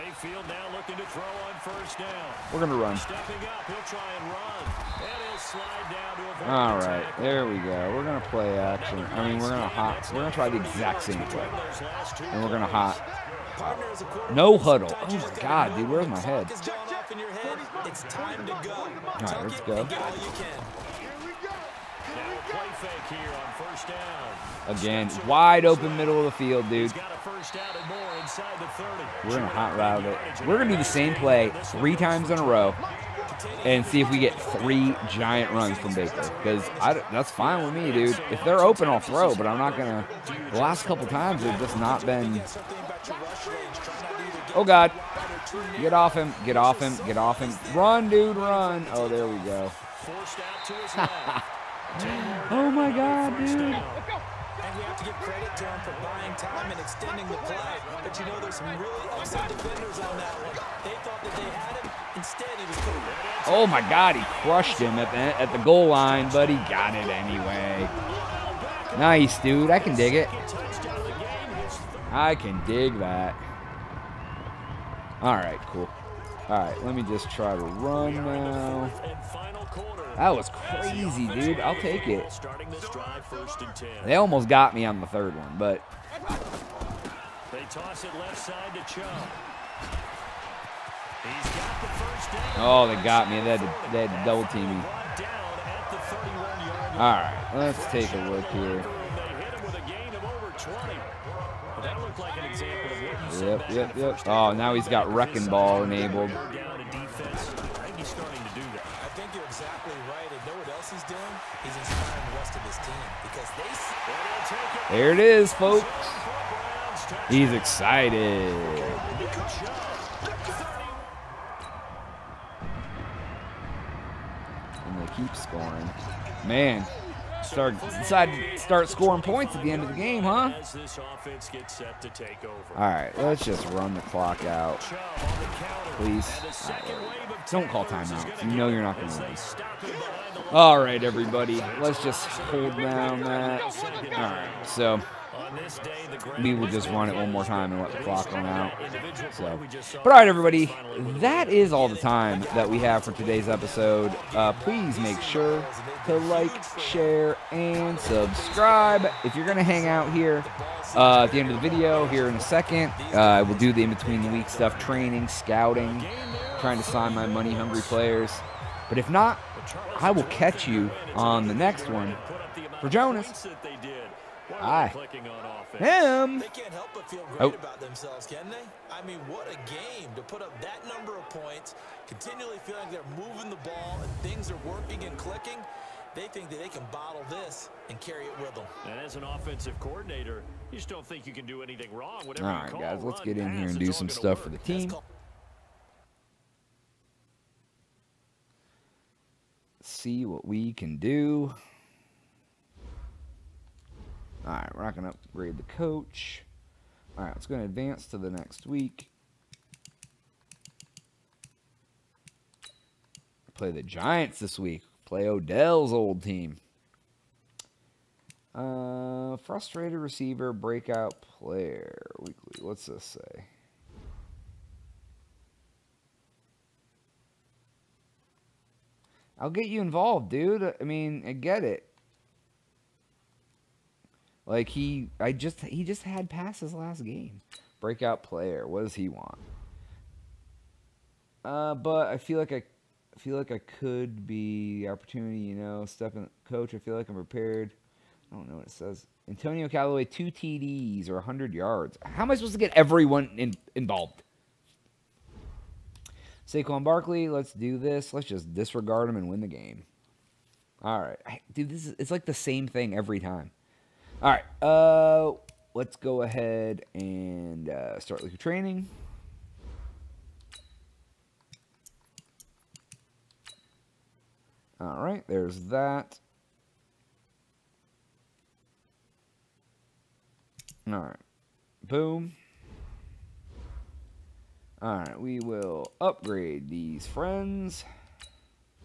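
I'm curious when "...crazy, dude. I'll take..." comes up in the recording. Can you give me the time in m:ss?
1:20.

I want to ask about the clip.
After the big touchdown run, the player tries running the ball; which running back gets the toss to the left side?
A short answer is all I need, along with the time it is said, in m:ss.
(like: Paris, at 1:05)
Chubb, at 1:28.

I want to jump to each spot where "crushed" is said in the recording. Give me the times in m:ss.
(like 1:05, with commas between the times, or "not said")
1:04.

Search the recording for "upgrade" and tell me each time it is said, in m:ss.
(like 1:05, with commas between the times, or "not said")
3:25, 4:45.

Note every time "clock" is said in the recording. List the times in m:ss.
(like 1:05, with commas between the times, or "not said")
2:14, 2:27.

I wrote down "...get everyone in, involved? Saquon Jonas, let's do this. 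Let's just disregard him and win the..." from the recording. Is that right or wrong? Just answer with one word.
wrong.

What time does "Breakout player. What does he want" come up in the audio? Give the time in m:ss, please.
3:57.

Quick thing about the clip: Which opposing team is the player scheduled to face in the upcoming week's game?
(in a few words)
Giants.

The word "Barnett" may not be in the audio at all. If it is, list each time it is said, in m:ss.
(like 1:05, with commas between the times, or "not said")
not said.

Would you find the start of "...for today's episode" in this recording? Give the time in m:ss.
2:33.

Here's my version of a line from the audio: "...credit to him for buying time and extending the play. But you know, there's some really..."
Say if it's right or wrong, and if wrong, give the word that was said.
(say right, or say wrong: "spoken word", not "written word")
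right.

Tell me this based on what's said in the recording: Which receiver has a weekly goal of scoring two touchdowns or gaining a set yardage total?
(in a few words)
Antonio Callaway.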